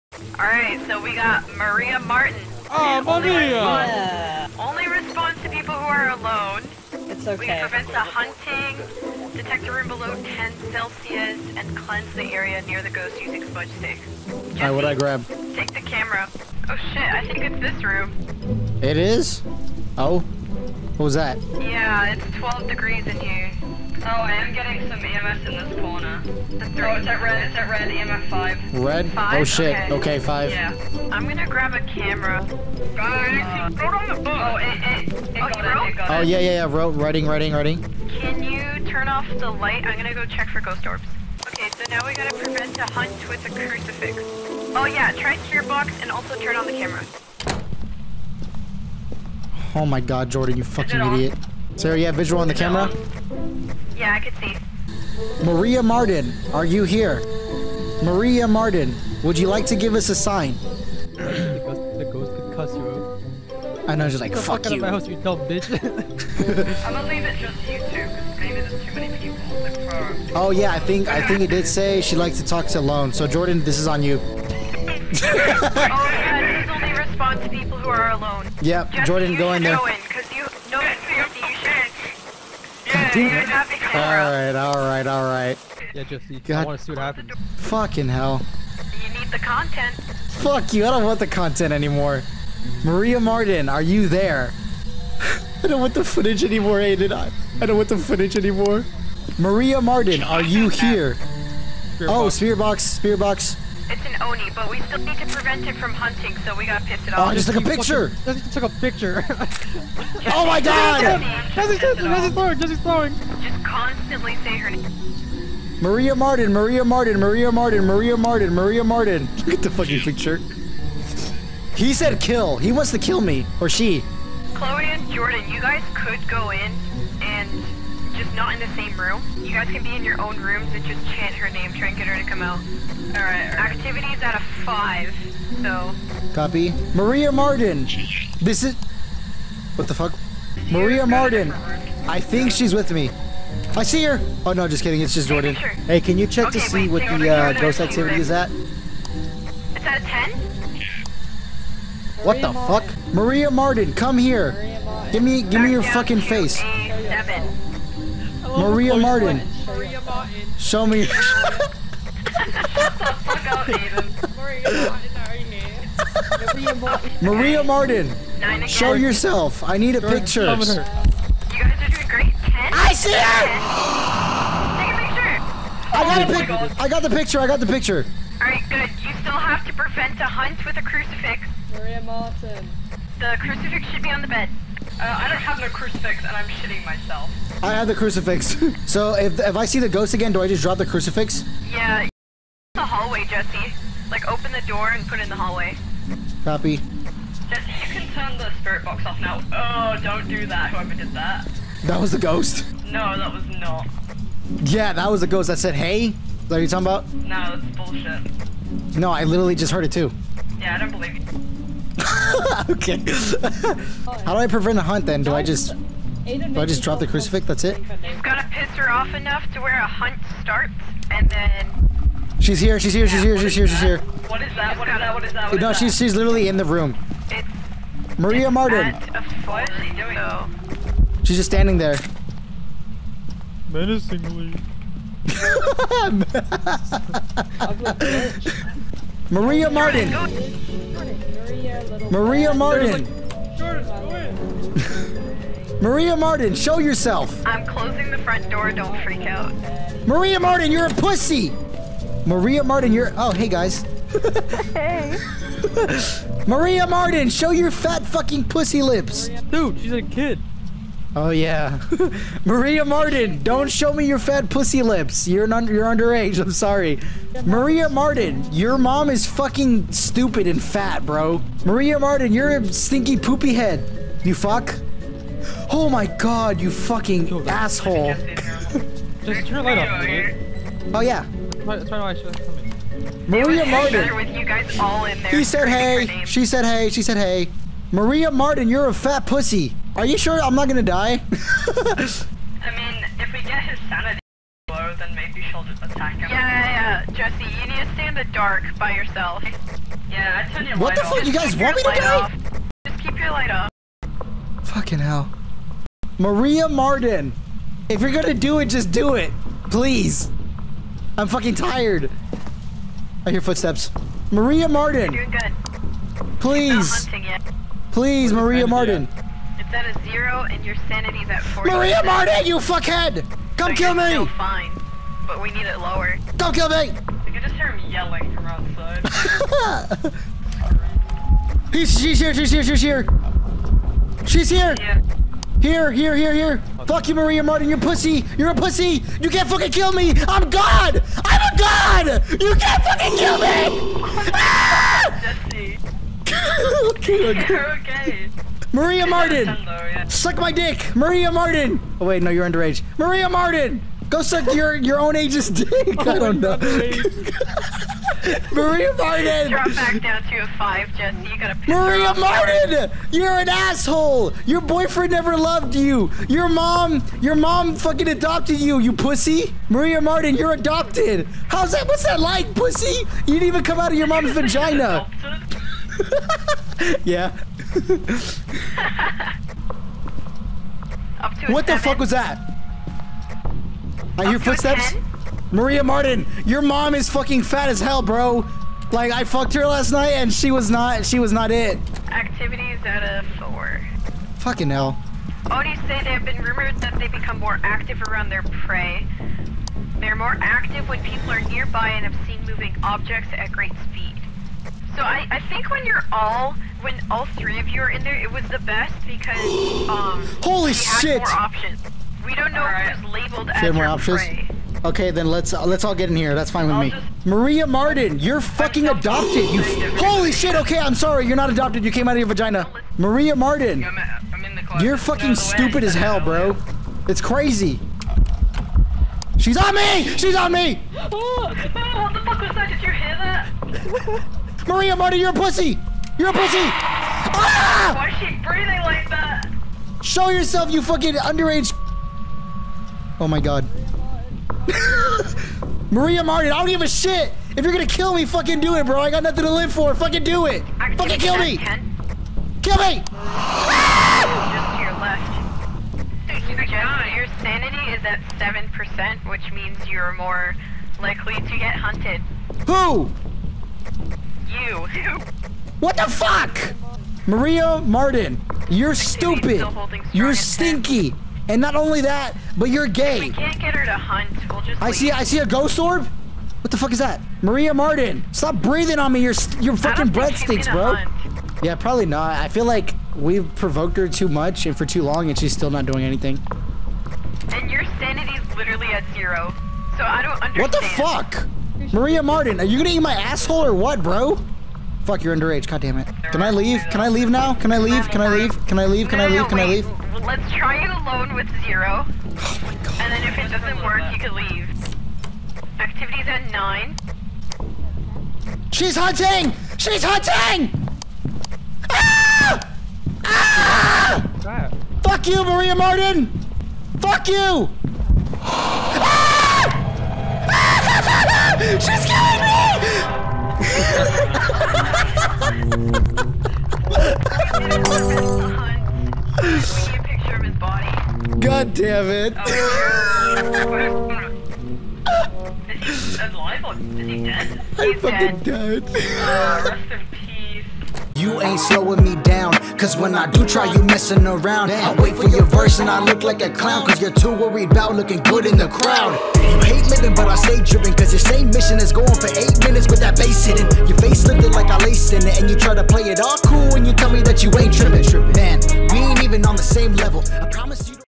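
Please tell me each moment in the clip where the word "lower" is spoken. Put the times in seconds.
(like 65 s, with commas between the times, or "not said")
325 s.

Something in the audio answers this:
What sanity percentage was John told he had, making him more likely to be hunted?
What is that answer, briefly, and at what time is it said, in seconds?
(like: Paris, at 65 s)
7%, at 458 s.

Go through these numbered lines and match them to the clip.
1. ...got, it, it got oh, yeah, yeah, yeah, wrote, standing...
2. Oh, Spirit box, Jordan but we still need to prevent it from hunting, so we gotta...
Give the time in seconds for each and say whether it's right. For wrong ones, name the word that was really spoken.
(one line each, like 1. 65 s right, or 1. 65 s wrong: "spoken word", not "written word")
1. 35 s wrong: "writing", not "standing"
2. 102 s wrong: "Spearbox", not "Jordan".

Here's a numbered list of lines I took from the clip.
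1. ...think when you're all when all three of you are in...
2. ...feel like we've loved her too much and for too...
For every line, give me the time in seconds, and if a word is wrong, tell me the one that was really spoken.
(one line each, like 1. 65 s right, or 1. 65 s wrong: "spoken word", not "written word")
1. 405 s right
2. 482 s wrong: "provoked", not "loved".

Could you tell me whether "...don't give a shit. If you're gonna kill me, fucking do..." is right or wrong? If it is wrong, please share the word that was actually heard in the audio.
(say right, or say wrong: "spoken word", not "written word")
right.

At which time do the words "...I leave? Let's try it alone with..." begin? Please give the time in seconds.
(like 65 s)
499 s.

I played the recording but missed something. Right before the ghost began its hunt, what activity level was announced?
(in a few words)
9.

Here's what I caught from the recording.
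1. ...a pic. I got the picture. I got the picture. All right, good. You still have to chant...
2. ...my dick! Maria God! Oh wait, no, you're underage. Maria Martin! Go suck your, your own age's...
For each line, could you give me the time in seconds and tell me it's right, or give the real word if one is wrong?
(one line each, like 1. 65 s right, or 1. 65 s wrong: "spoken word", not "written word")
1. 176 s wrong: "prevent", not "chant"
2. 350 s wrong: "Martin", not "God".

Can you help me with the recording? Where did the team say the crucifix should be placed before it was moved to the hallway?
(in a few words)
On the bed.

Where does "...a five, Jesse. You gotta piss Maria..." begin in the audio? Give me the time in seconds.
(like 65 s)
360 s.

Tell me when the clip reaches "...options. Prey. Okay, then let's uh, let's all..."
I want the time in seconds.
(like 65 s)
413 s.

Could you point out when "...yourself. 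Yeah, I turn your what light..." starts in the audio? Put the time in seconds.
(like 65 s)
298 s.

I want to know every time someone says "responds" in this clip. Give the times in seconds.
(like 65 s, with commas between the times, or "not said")
4 s, 76 s.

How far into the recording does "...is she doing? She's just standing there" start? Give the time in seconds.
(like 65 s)
229 s.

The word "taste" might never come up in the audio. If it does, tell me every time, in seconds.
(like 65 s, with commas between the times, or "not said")
not said.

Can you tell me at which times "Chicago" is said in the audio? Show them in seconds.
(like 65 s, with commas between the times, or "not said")
not said.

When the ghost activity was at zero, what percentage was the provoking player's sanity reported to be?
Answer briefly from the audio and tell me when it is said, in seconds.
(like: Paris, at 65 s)
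40, at 320 s.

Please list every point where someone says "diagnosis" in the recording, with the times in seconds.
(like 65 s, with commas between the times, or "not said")
not said.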